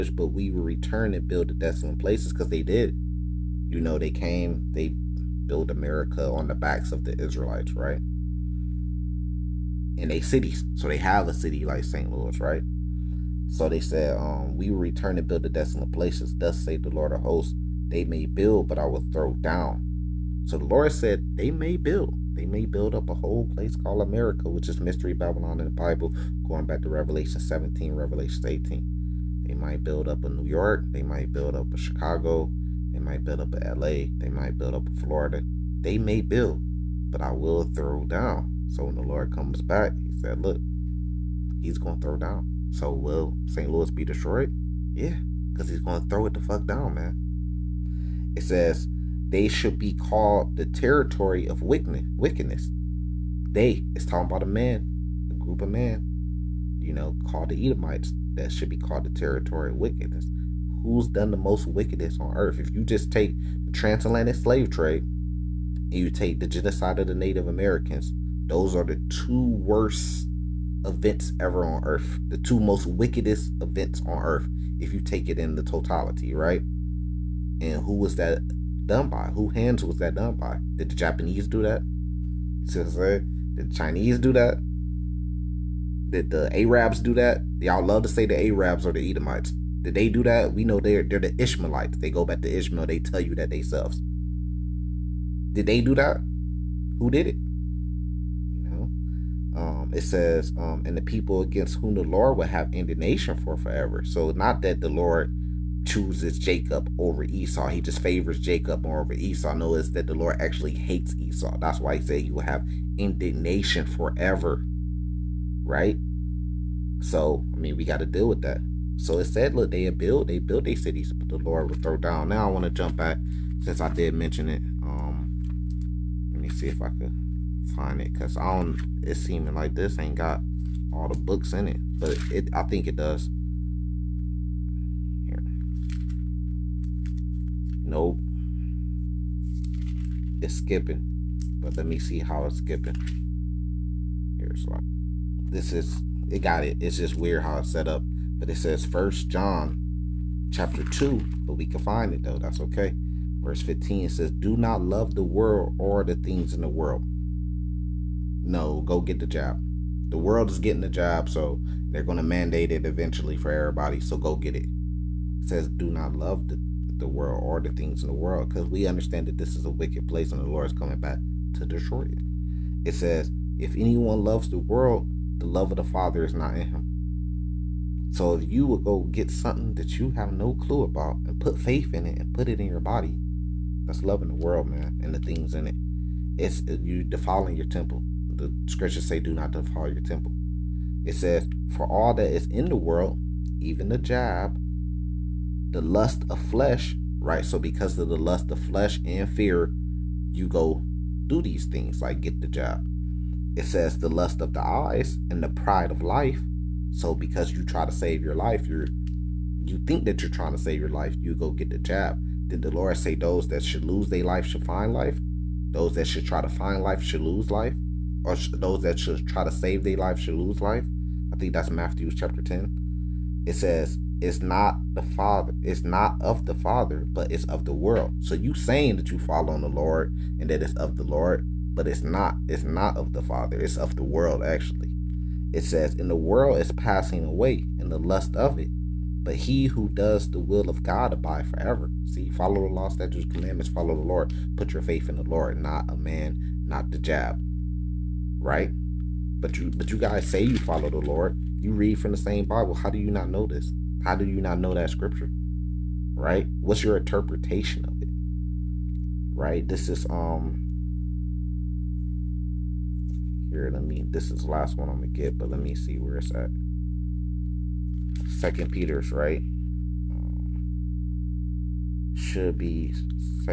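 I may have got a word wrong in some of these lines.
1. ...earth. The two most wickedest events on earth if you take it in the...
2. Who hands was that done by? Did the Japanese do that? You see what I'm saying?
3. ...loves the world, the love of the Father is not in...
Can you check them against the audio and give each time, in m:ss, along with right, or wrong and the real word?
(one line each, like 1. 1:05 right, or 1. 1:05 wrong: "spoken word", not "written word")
1. 1:11 right
2. 1:19 right
3. 2:54 right.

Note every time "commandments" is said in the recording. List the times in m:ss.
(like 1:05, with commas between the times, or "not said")
4:03.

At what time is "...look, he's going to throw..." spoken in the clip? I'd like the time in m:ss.
0:40.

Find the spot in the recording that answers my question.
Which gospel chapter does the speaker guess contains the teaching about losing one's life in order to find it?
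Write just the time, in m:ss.
3:41.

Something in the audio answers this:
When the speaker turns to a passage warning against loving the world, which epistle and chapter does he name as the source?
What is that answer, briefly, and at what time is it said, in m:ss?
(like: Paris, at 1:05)
First John chapter 2, at 2:28.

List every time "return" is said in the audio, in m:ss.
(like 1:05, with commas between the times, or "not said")
0:00, 0:14.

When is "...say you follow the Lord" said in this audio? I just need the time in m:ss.
4:10.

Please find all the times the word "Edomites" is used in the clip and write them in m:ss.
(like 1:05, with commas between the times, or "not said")
0:57, 1:29.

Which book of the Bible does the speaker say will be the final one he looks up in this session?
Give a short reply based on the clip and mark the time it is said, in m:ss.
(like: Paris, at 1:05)
Second Peter, at 4:28.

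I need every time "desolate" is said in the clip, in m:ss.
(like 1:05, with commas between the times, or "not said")
0:01, 0:15.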